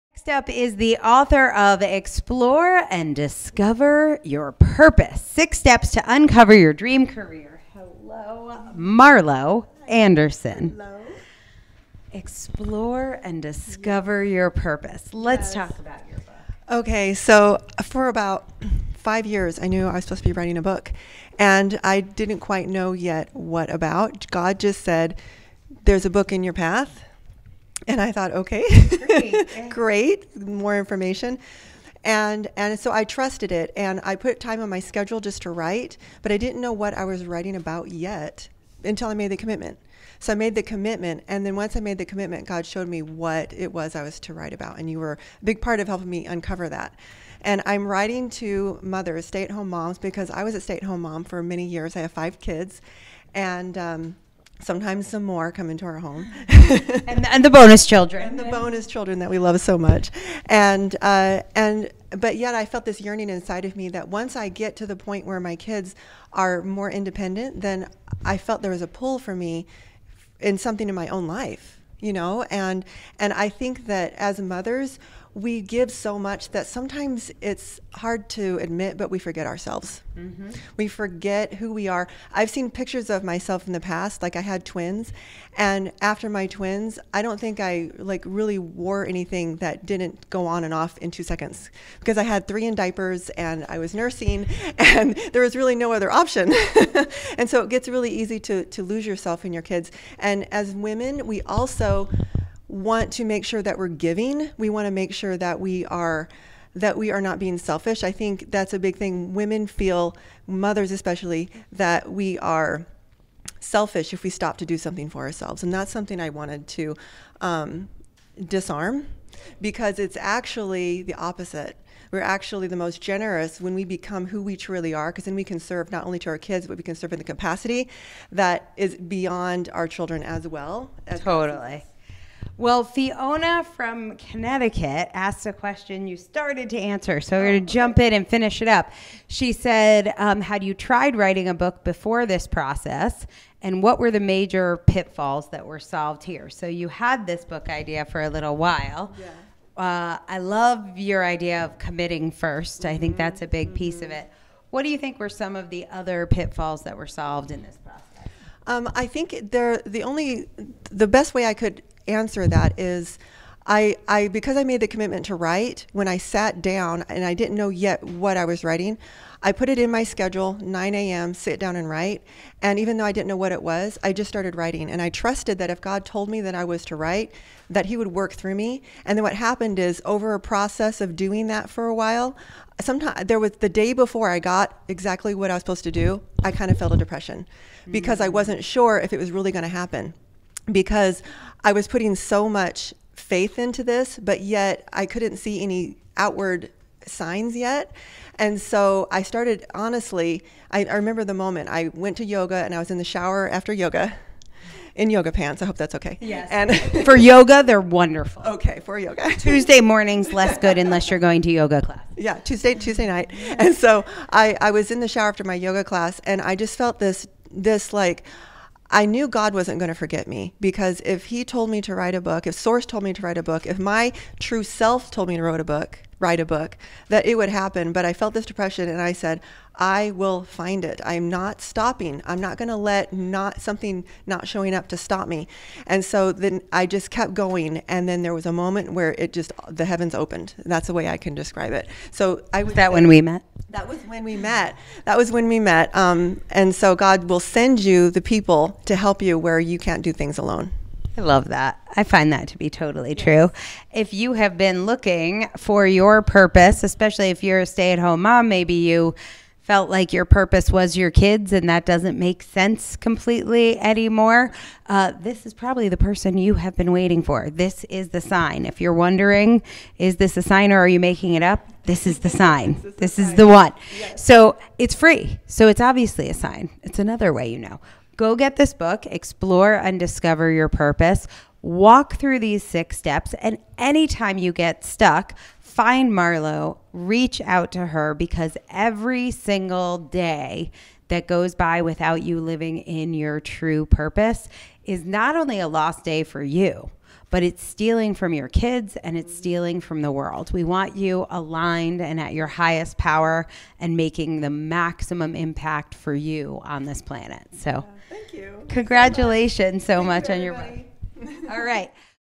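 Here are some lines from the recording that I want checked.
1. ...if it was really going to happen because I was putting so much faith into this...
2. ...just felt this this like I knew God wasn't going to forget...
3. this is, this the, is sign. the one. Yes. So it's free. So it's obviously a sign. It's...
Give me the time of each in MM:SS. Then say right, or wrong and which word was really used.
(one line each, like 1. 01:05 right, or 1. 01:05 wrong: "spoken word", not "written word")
1. 03:08 right
2. 03:36 right
3. 04:32 right.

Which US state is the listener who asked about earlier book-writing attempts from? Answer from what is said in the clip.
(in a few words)
Connecticut.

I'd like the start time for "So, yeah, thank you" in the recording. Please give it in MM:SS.
05:07.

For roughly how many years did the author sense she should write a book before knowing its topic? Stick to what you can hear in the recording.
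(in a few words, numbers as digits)
5 years.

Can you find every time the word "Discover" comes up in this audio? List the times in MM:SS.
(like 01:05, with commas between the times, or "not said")
00:03, 00:13, 04:39.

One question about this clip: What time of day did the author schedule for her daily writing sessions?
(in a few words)
9 a.m.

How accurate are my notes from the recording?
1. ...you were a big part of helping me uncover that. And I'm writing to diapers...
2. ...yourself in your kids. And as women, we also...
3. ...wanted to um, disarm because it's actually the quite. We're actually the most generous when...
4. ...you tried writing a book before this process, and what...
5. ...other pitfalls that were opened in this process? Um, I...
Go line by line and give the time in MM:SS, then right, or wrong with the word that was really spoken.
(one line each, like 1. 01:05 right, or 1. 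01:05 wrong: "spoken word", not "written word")
1. 00:44 wrong: "mothers", not "diapers"
2. 01:39 right
3. 01:56 wrong: "opposite", not "quite"
4. 02:20 right
5. 02:35 wrong: "solved", not "opened".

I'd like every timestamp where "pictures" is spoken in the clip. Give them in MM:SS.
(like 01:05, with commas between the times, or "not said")
01:22.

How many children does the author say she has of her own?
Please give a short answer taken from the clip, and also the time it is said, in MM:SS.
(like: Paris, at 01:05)
5, at 00:52.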